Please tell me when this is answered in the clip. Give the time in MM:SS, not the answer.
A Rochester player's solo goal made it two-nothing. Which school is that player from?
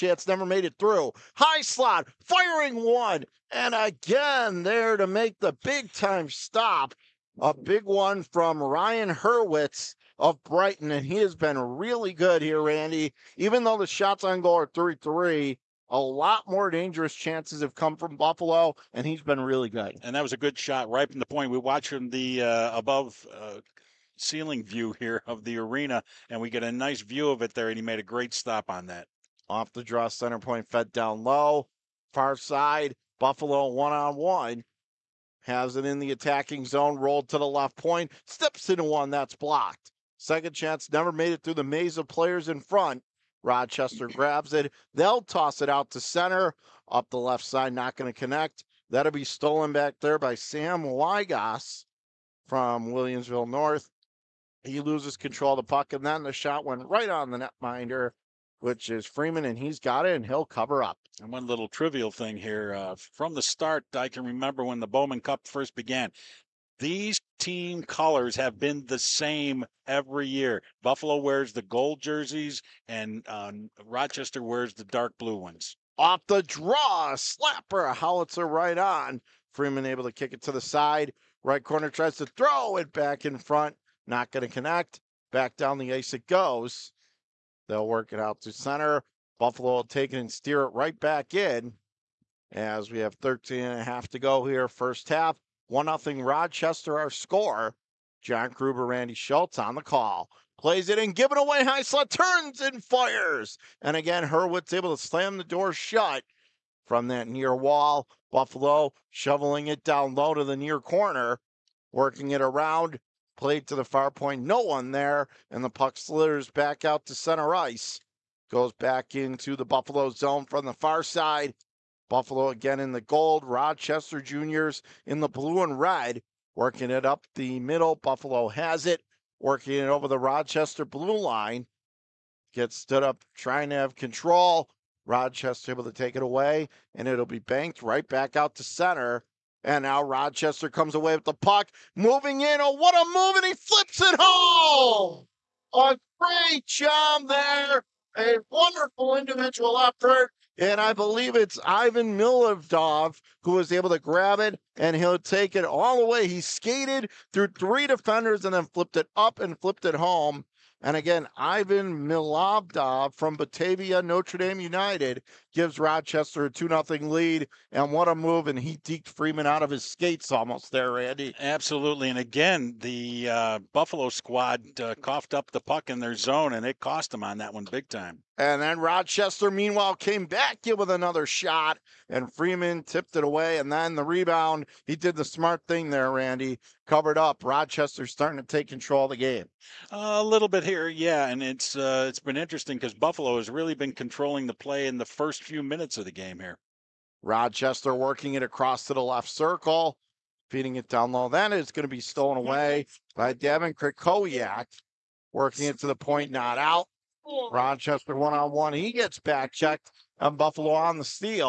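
02:43.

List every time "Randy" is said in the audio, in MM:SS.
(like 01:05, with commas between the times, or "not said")
00:12, 01:38, 02:50, 03:06.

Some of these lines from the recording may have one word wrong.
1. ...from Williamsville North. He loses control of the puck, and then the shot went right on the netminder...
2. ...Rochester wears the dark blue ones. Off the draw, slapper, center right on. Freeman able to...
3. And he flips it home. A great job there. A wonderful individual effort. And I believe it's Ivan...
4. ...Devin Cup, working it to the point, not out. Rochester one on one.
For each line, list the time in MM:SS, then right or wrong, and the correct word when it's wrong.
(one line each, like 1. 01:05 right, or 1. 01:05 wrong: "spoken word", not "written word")
1. 00:52 right
2. 01:13 wrong: "howitzer", not "center"
3. 02:23 right
4. 03:23 wrong: "Krikowiak", not "Cup".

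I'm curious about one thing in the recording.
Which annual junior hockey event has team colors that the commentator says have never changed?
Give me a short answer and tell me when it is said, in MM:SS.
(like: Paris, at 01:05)
Bowman Cup, at 01:04.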